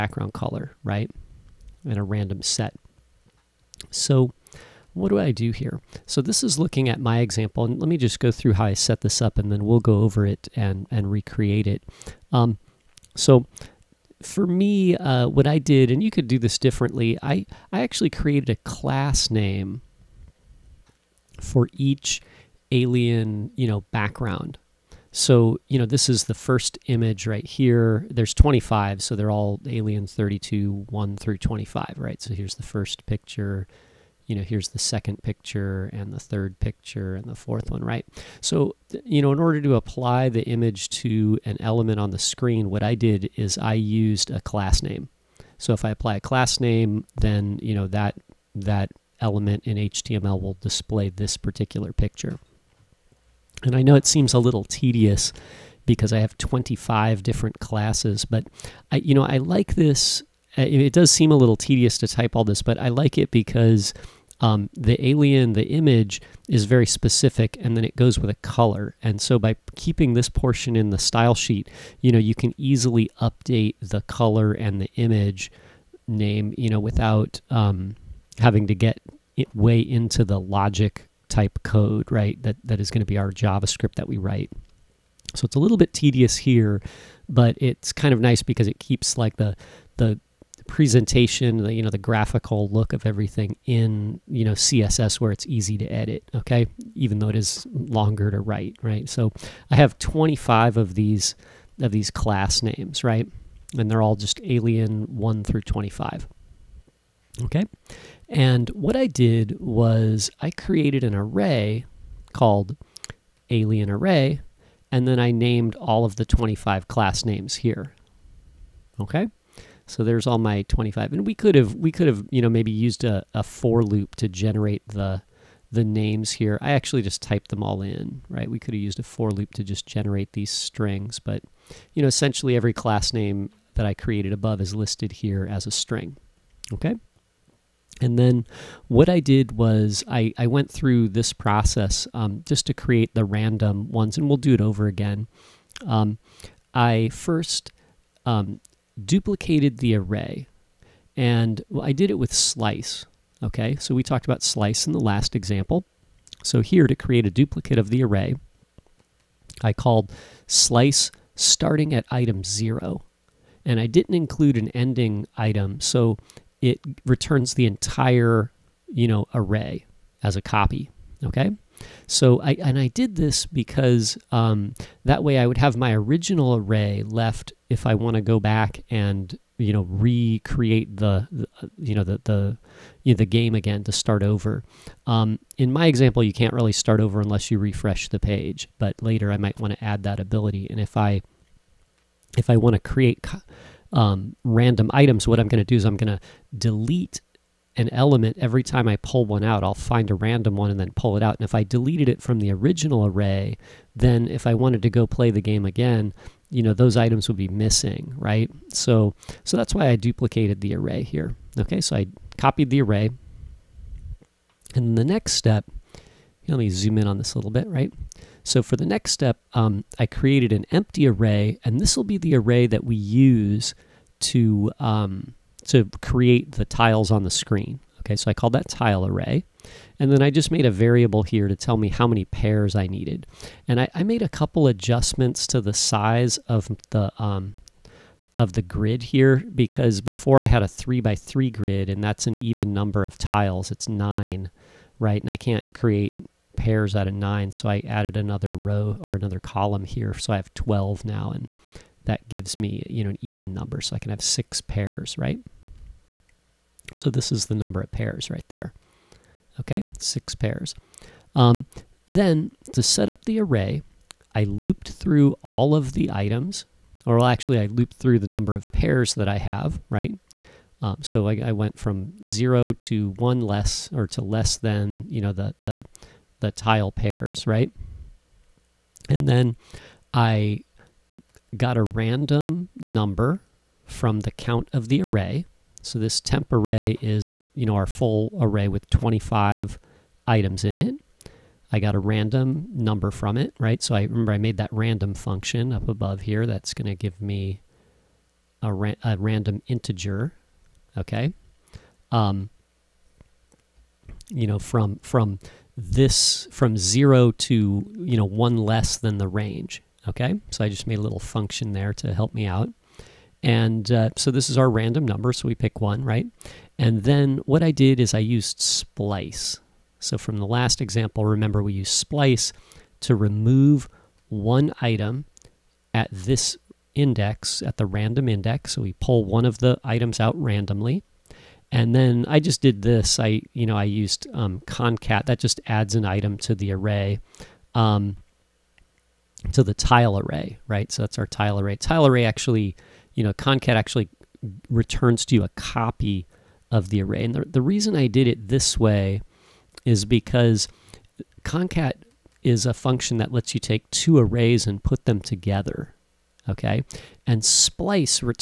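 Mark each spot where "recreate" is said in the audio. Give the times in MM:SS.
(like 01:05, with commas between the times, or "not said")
00:11, 02:59.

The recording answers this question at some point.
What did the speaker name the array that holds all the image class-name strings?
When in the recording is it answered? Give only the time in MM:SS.
01:53.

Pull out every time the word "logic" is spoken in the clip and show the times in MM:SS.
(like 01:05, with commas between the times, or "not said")
01:20.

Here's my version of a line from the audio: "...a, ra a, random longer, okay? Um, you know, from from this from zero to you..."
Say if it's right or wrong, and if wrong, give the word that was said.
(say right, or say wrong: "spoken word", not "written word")
wrong: "integer", not "longer".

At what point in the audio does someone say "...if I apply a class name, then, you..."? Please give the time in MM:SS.
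00:45.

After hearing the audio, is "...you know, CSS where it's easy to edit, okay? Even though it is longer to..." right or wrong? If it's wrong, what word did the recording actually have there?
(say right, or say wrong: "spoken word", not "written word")
right.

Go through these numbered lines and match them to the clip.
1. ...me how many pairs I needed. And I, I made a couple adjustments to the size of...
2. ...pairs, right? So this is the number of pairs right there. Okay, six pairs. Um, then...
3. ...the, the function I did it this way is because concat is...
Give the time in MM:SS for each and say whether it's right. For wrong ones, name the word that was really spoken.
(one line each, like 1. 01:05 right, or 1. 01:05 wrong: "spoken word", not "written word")
1. 03:51 right
2. 04:14 right
3. 05:47 wrong: "reason", not "function".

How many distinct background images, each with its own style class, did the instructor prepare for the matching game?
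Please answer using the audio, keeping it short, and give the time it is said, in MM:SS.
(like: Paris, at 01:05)
25, at 00:28.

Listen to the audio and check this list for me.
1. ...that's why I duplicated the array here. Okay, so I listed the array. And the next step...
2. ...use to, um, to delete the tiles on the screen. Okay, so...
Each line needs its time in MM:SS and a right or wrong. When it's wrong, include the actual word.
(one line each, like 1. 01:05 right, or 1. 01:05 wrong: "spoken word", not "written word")
1. 03:29 wrong: "copied", not "listed"
2. 03:42 wrong: "create", not "delete".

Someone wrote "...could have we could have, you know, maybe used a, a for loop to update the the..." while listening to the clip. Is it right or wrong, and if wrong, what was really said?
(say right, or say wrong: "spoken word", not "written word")
wrong: "generate", not "update".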